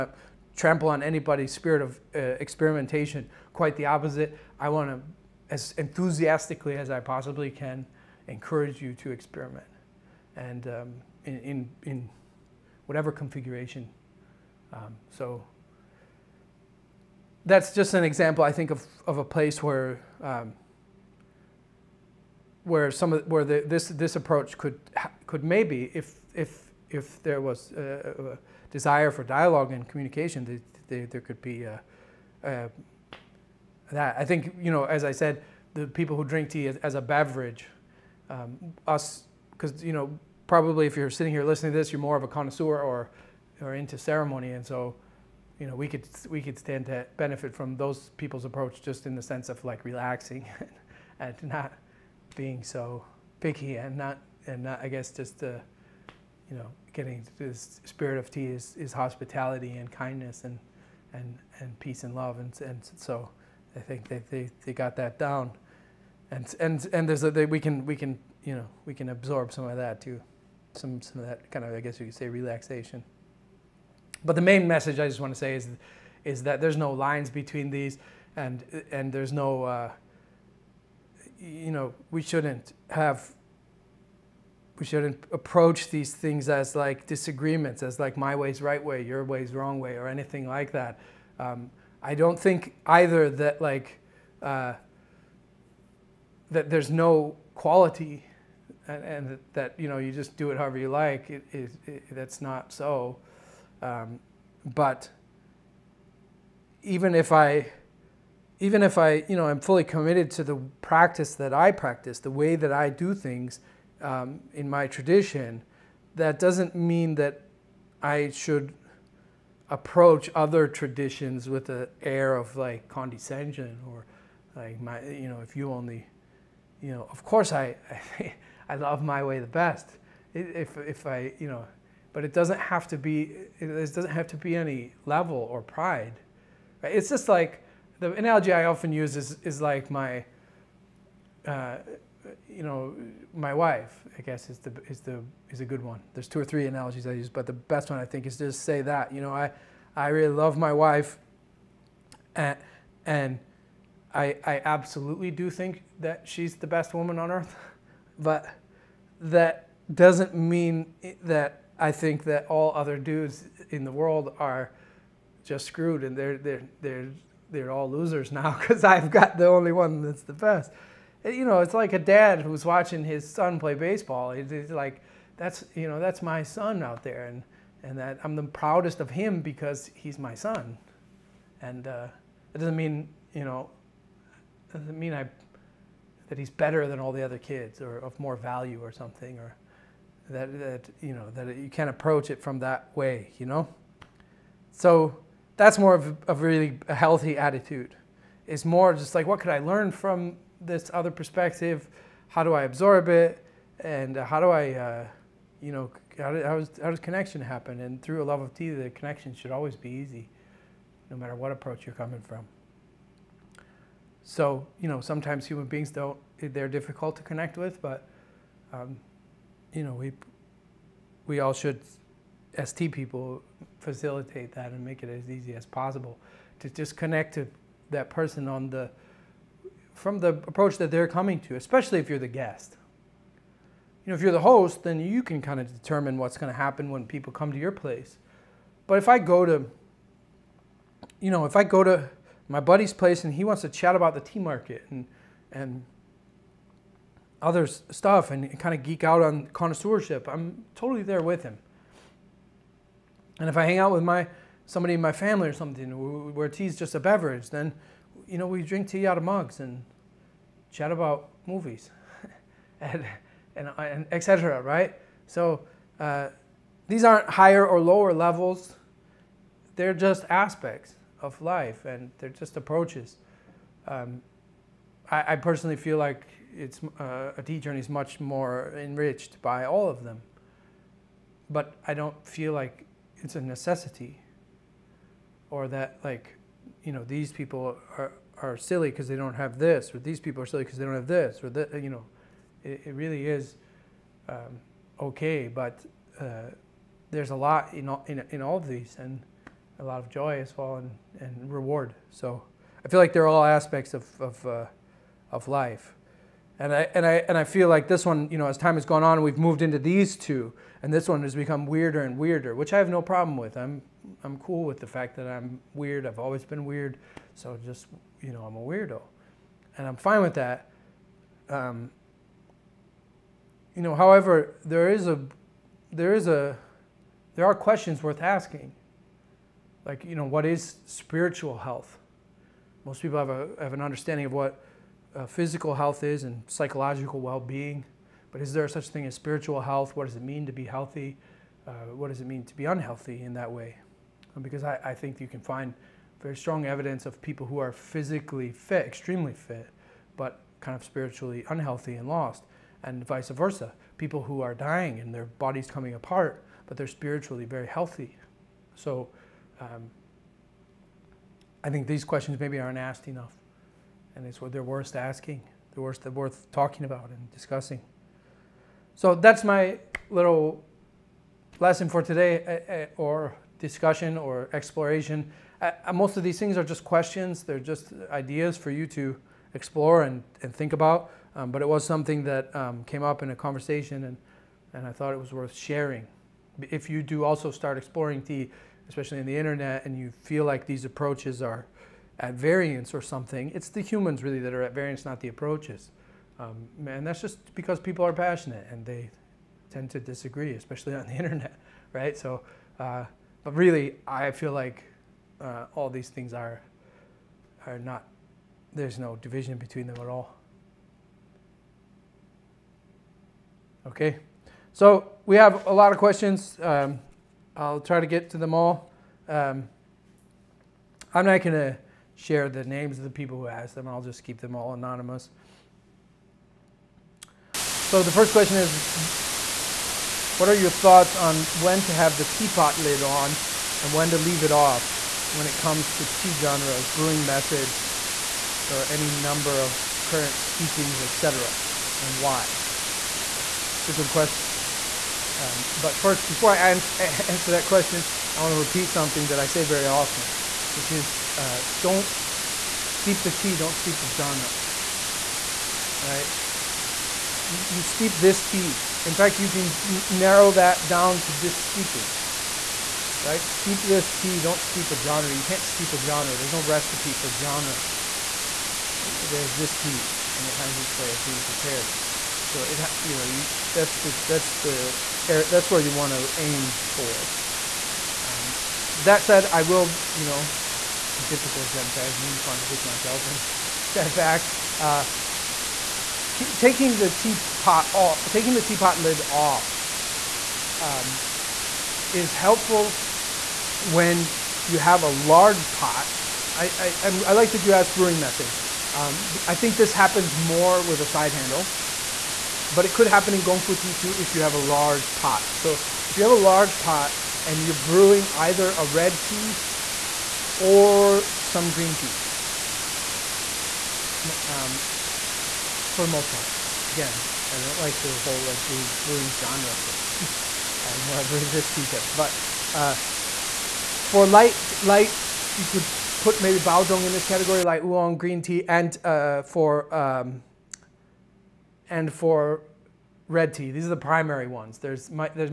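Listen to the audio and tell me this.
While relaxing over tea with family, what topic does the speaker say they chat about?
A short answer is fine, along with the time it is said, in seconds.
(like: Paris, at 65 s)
movies, at 261 s.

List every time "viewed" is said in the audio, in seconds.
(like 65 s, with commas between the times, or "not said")
not said.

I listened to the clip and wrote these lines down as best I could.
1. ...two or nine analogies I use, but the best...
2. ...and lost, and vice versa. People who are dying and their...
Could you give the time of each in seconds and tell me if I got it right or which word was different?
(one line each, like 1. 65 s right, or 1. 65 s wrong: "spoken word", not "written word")
1. 146 s wrong: "three", not "nine"
2. 351 s right.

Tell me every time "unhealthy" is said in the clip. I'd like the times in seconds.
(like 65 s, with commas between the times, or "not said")
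342 s, 351 s.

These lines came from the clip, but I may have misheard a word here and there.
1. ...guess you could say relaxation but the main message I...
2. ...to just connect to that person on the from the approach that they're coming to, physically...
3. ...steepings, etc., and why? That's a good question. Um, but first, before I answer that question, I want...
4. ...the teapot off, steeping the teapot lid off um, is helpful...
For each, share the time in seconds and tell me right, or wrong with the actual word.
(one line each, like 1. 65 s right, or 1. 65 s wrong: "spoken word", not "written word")
1. 71 s right
2. 226 s wrong: "especially", not "physically"
3. 440 s right
4. 486 s wrong: "taking", not "steeping".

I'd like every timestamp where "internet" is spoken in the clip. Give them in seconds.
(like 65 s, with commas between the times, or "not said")
389 s, 401 s.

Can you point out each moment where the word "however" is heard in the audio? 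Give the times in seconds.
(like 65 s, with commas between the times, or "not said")
100 s, 323 s.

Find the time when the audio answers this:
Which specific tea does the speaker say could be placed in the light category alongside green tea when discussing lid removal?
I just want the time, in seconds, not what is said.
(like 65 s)
526 s.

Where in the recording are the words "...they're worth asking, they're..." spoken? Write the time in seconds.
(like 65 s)
364 s.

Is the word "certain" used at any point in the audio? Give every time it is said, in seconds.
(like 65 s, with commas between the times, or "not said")
not said.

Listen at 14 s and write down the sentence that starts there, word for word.
Um, so that's just an example, I think, of, of a place where.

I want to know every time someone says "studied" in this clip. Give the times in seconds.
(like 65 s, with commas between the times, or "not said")
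not said.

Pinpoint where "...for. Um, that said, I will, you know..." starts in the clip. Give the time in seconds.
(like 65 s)
476 s.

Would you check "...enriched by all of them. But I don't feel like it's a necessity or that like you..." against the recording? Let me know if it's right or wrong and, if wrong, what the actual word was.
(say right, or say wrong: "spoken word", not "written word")
right.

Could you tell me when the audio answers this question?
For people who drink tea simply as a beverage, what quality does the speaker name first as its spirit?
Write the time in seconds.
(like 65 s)
58 s.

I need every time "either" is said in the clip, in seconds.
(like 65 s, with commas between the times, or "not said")
92 s, 508 s.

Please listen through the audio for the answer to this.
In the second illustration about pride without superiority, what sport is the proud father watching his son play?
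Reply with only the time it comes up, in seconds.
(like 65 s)
173 s.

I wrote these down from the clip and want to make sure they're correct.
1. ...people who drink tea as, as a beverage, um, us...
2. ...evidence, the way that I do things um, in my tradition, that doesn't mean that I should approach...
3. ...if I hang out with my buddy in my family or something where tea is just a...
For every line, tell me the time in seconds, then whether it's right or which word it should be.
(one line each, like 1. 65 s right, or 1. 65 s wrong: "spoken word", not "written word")
1. 35 s right
2. 111 s wrong: "practice", not "evidence"
3. 253 s wrong: "somebody", not "buddy".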